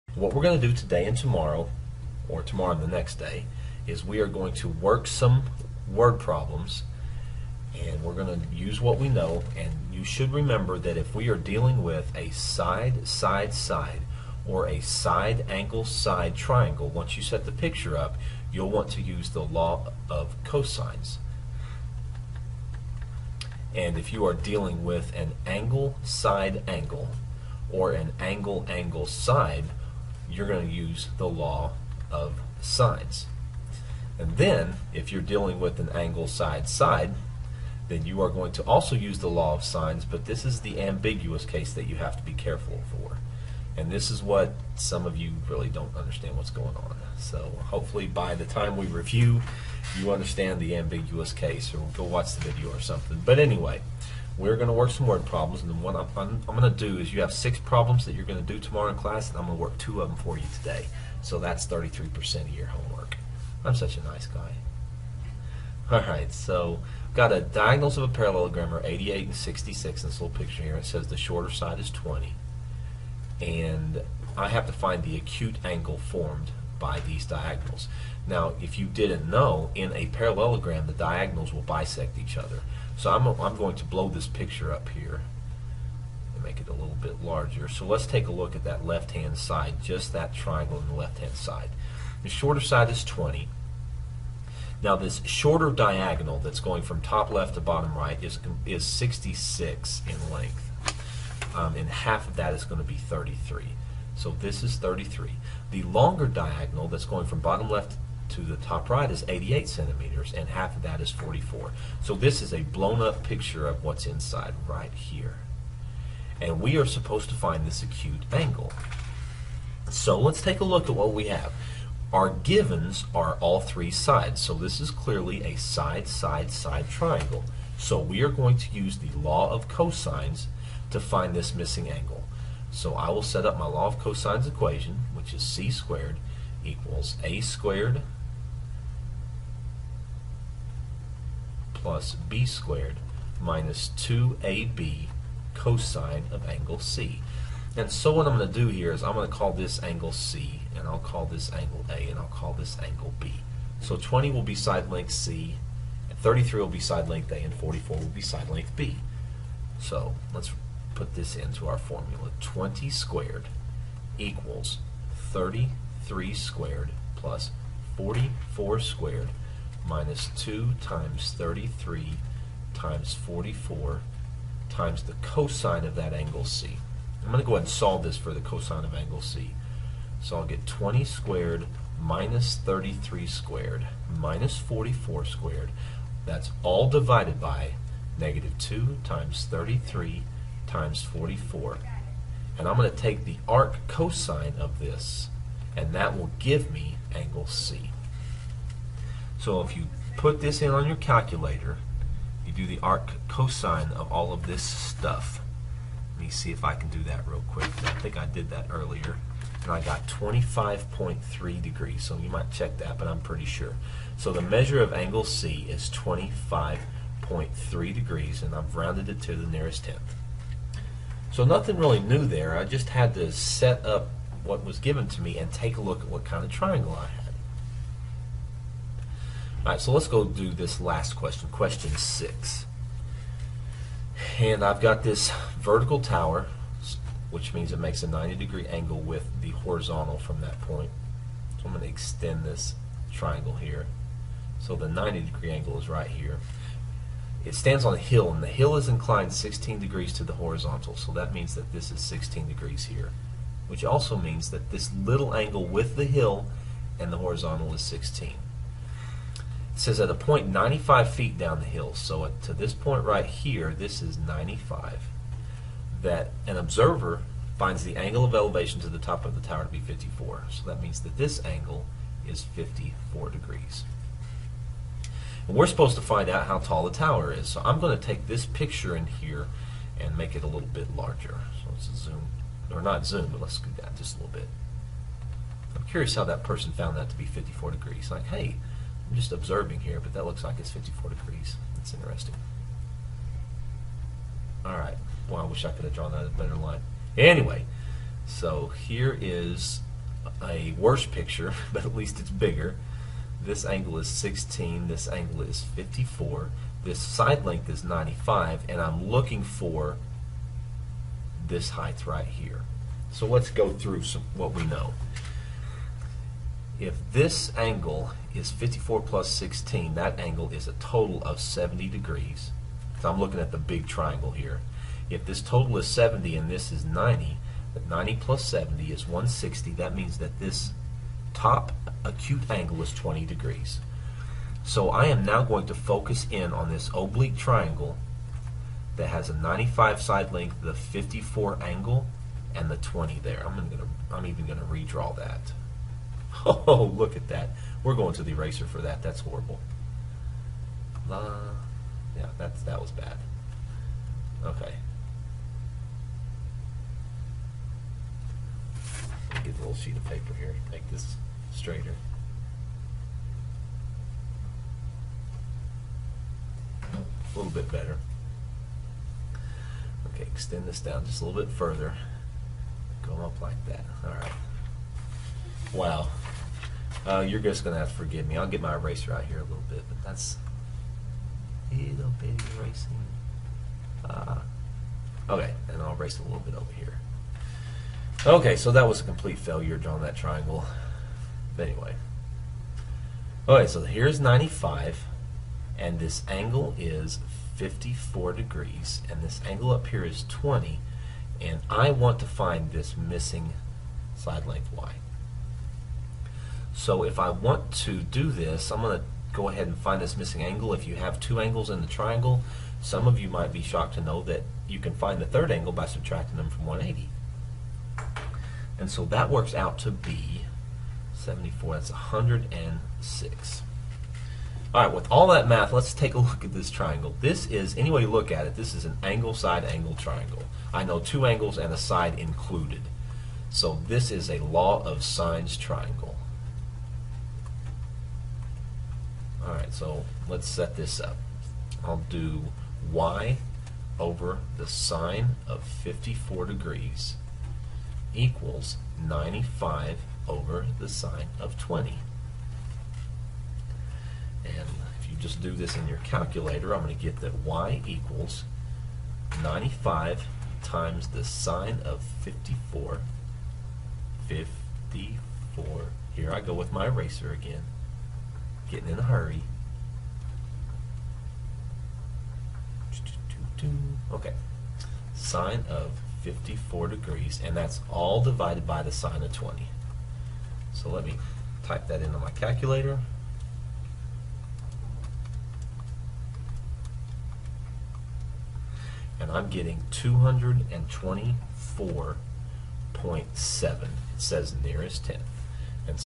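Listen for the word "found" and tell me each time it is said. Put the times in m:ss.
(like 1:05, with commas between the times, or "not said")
4:46.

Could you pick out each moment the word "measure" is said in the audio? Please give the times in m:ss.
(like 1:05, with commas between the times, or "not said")
3:34.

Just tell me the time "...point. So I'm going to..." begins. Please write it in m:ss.
4:00.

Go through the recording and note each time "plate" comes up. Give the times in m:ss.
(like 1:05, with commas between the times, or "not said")
not said.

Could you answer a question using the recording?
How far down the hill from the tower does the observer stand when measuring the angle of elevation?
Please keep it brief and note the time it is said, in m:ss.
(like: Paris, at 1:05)
95 feet, at 4:20.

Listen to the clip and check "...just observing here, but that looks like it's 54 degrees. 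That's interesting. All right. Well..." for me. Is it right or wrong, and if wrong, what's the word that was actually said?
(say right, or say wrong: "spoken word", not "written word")
right.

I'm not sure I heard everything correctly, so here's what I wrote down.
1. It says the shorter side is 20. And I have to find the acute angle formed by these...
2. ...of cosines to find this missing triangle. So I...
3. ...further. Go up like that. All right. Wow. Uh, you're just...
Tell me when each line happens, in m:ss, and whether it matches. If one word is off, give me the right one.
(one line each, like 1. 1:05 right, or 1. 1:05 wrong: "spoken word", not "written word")
1. 1:10 right
2. 2:09 wrong: "angle", not "triangle"
3. 6:11 right.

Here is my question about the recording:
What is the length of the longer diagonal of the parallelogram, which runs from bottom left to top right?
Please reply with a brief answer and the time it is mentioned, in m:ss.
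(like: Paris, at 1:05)
88 centimeters, at 1:49.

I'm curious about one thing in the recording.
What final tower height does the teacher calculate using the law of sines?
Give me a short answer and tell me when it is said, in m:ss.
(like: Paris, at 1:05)
224.7, at 8:09.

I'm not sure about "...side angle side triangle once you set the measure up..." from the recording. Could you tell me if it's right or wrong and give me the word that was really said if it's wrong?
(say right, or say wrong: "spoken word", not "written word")
wrong: "picture", not "measure".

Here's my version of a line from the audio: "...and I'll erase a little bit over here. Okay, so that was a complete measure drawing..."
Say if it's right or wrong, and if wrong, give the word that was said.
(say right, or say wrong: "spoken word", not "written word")
wrong: "failure", not "measure".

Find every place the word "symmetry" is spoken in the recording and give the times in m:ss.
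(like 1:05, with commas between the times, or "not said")
not said.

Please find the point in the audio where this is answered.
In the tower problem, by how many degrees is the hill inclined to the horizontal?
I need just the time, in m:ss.
4:08.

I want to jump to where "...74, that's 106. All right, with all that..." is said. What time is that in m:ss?
7:01.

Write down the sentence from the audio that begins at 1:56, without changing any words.
And we are supposed to find this acute angle.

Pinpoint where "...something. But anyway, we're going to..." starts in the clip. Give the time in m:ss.
0:52.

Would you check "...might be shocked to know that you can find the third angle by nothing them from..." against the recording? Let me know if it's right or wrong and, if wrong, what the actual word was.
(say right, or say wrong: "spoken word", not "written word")
wrong: "subtracting", not "nothing".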